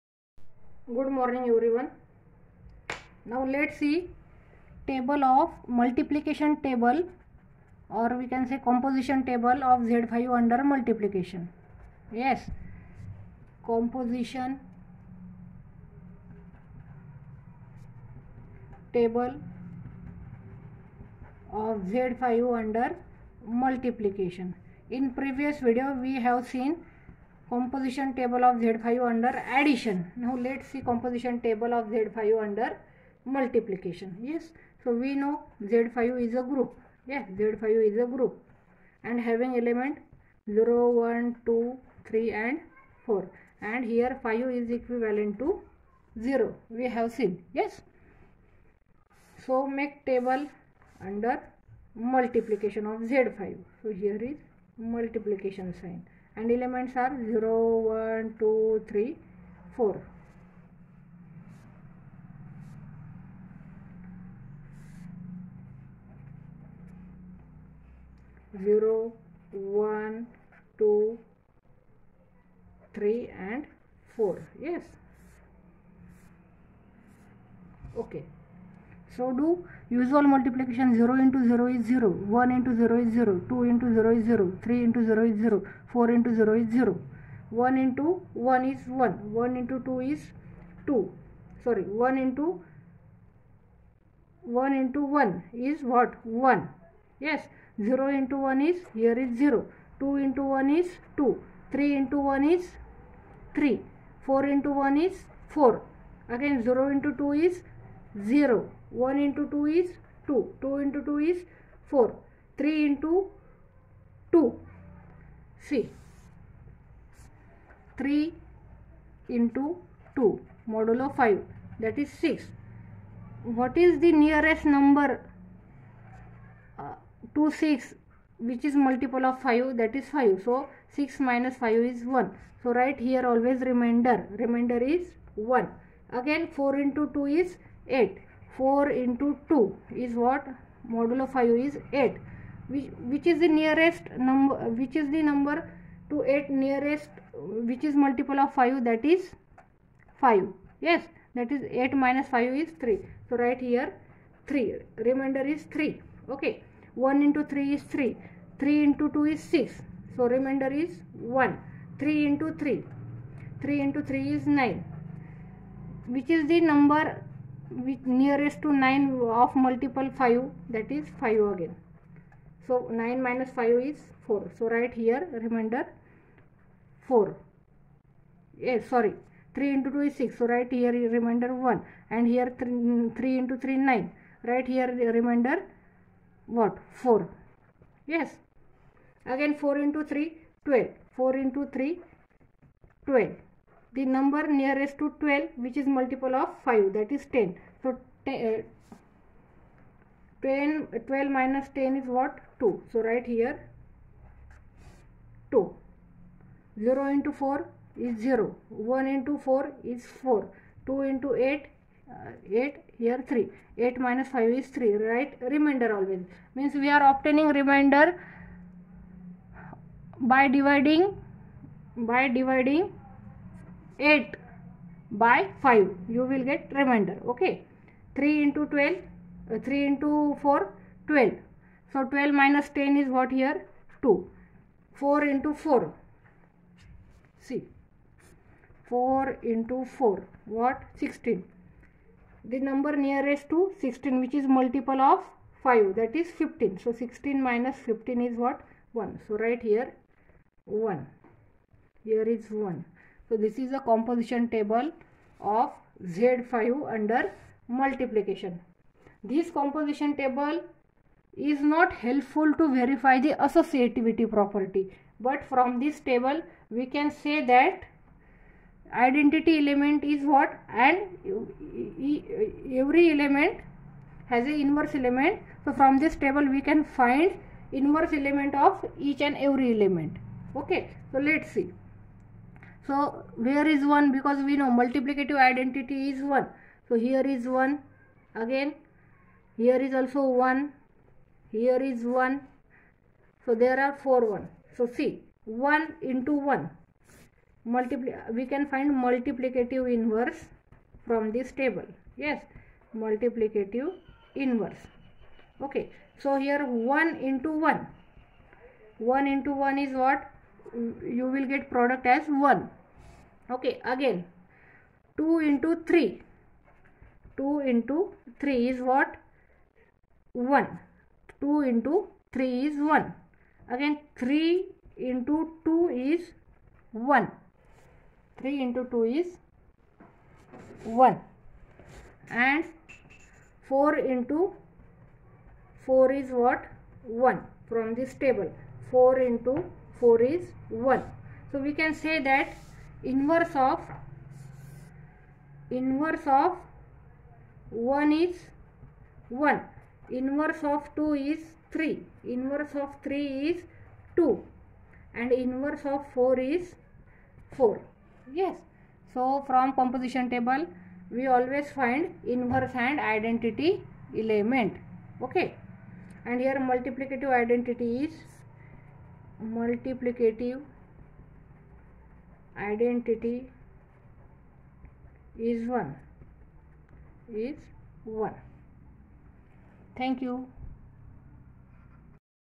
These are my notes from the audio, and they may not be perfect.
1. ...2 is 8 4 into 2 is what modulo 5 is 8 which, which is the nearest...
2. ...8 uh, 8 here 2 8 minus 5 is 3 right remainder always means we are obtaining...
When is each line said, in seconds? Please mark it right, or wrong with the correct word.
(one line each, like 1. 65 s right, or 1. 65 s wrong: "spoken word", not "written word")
1. 137 s right
2. 211 s wrong: "3", not "2".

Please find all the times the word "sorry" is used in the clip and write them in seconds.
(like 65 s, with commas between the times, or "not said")
91 s, 178 s.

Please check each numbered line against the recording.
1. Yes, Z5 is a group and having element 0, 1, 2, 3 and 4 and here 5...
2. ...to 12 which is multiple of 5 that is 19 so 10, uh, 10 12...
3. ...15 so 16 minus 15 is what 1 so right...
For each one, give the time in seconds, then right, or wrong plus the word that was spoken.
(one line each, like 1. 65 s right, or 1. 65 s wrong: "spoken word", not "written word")
1. 37 s right
2. 194 s wrong: "10", not "19"
3. 246 s right.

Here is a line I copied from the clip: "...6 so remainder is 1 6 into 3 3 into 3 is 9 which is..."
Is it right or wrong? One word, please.
wrong.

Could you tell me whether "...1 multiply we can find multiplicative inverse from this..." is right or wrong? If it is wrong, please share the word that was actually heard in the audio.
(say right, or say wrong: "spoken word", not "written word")
right.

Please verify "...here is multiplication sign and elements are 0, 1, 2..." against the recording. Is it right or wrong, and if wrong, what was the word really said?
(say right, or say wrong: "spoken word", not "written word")
right.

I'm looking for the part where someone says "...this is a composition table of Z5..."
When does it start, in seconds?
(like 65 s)
253 s.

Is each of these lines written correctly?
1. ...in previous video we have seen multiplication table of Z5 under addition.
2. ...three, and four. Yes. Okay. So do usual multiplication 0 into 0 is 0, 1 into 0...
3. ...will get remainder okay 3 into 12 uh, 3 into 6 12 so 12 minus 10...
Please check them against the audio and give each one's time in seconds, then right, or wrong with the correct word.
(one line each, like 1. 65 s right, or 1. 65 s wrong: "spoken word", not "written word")
1. 24 s wrong: "composition", not "multiplication"
2. 72 s right
3. 226 s wrong: "4", not "6".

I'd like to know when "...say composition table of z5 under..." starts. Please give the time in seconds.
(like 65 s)
8 s.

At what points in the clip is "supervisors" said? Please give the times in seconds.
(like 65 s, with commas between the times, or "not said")
not said.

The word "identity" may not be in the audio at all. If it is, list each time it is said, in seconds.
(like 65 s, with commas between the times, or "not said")
268 s, 285 s, 362 s, 367 s, 372 s.